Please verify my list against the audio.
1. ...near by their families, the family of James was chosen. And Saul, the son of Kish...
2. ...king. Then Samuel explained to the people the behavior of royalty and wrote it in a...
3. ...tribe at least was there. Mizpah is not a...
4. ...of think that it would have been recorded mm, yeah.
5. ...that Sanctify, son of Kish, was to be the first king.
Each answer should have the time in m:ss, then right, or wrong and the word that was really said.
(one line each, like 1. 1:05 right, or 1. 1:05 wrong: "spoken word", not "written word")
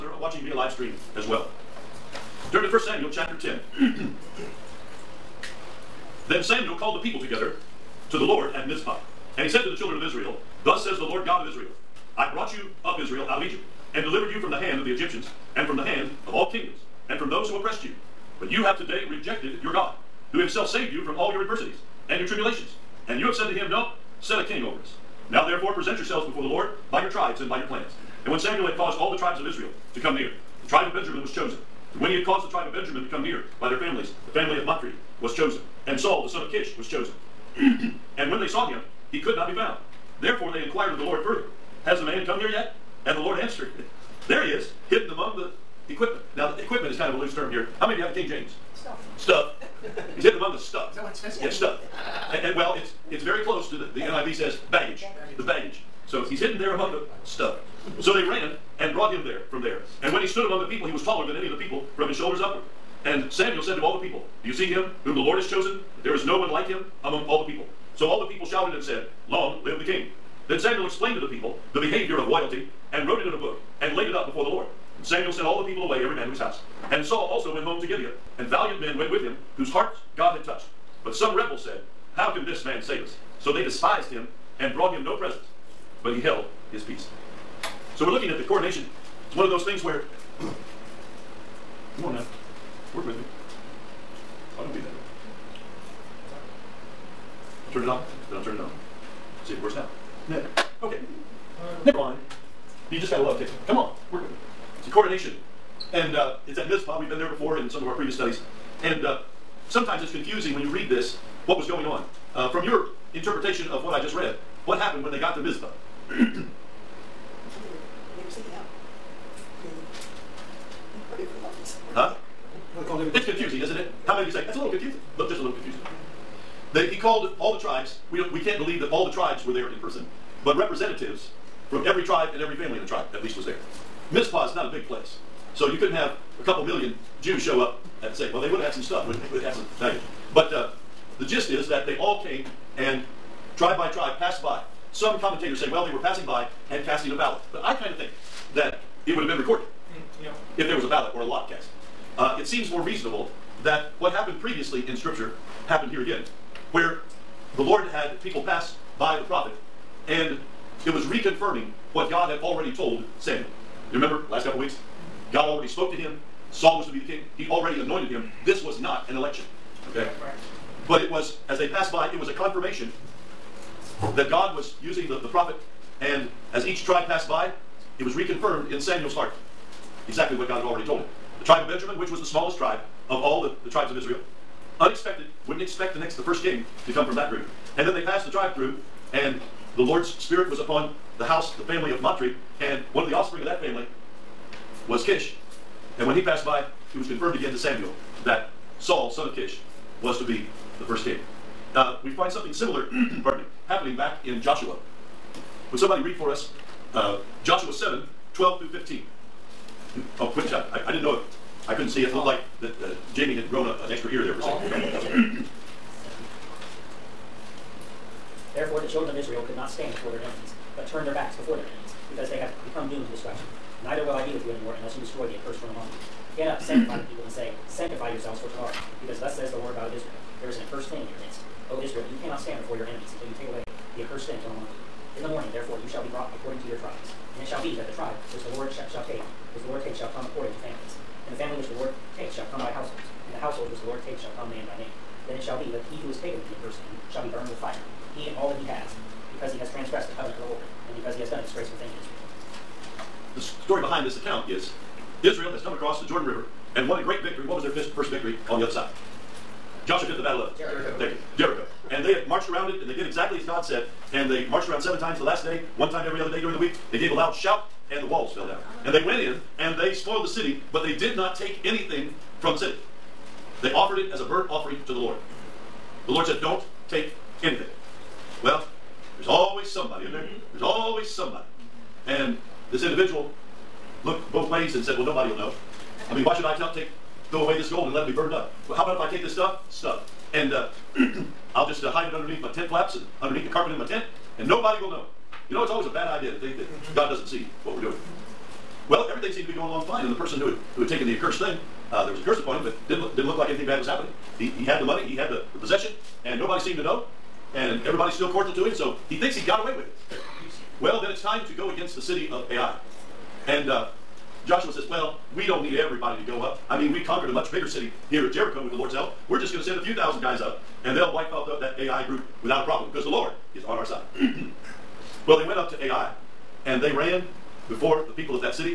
1. 0:33 wrong: "Matri", not "James"
2. 1:09 right
3. 2:12 right
4. 2:27 right
5. 3:18 wrong: "Saul", not "Sanctify".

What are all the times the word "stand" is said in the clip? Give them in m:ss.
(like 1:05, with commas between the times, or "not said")
3:39, 3:52.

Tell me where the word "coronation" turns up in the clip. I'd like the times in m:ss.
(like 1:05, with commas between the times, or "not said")
1:28, 1:44.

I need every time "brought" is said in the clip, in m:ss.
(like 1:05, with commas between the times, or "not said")
0:12, 0:58, 1:24.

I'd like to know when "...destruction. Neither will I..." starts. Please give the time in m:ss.
3:43.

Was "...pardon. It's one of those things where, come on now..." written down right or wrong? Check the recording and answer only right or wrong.
wrong.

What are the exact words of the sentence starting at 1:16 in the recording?
And Saul also went home to Gibeah, and valiant men went with him, whose hearts God had touched.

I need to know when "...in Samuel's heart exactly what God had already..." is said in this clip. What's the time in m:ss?
2:58.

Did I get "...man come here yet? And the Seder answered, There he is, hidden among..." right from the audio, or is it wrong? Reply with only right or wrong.
wrong.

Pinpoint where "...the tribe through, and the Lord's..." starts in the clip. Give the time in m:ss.
3:08.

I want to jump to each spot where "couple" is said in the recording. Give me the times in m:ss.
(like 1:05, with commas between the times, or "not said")
2:16, 2:44.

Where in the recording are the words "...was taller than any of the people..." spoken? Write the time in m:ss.
1:00.